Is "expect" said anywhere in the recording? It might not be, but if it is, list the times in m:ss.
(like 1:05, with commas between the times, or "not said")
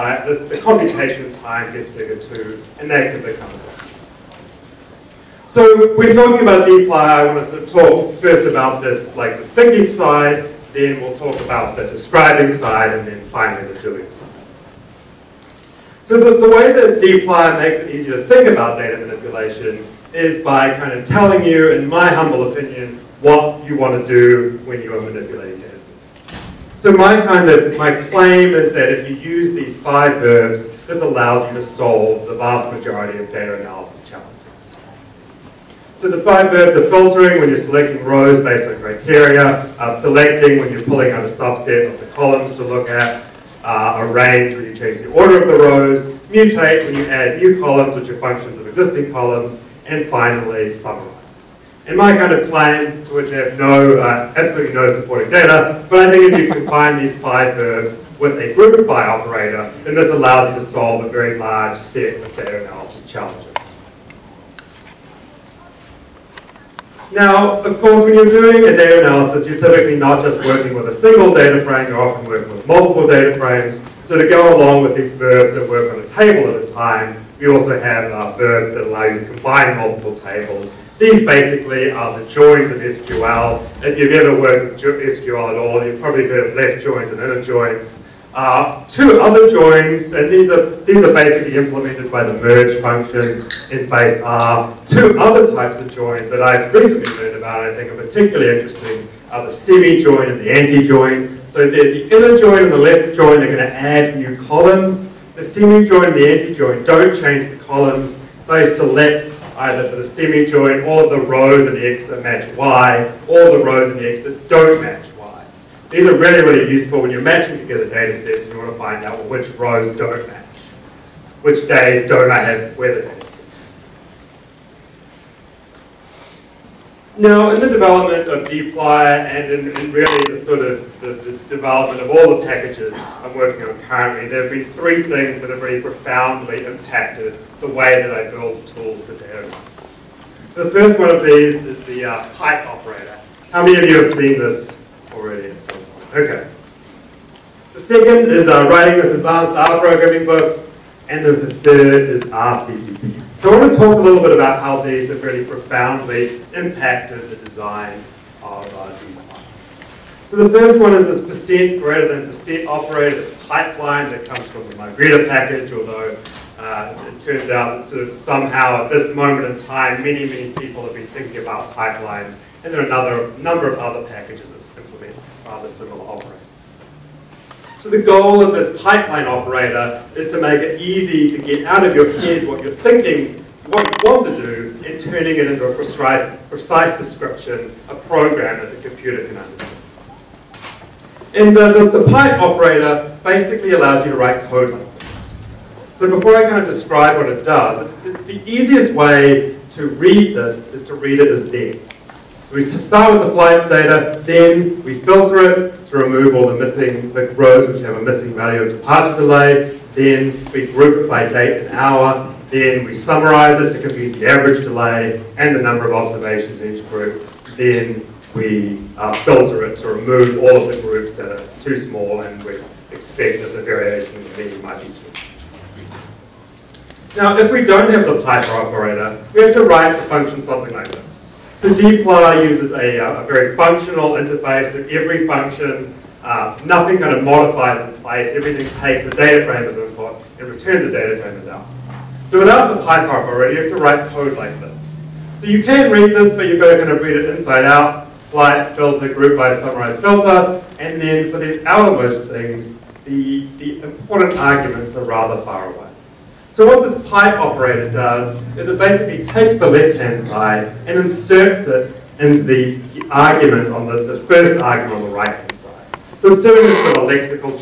3:42.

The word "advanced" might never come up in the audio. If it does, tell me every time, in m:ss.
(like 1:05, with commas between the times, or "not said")
2:29.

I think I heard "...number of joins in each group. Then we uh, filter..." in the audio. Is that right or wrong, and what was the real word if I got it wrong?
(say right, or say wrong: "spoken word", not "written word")
wrong: "observations", not "joins".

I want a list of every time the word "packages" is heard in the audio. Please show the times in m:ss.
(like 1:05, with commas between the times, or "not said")
2:12, 2:45, 2:54.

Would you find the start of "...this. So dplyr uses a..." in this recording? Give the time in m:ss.
3:50.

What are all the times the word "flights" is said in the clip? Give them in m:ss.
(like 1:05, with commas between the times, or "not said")
3:23, 4:08.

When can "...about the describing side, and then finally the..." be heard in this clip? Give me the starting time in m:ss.
0:11.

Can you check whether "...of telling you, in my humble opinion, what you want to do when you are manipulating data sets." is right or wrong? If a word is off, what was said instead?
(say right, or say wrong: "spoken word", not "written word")
right.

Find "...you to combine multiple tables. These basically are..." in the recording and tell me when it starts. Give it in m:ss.
1:19.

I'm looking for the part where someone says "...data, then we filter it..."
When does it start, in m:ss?
3:23.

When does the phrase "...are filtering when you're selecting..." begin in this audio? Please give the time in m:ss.
0:36.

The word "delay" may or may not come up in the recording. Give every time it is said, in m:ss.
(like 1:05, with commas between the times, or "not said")
3:29, 3:34.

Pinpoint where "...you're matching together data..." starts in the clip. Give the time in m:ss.
1:57.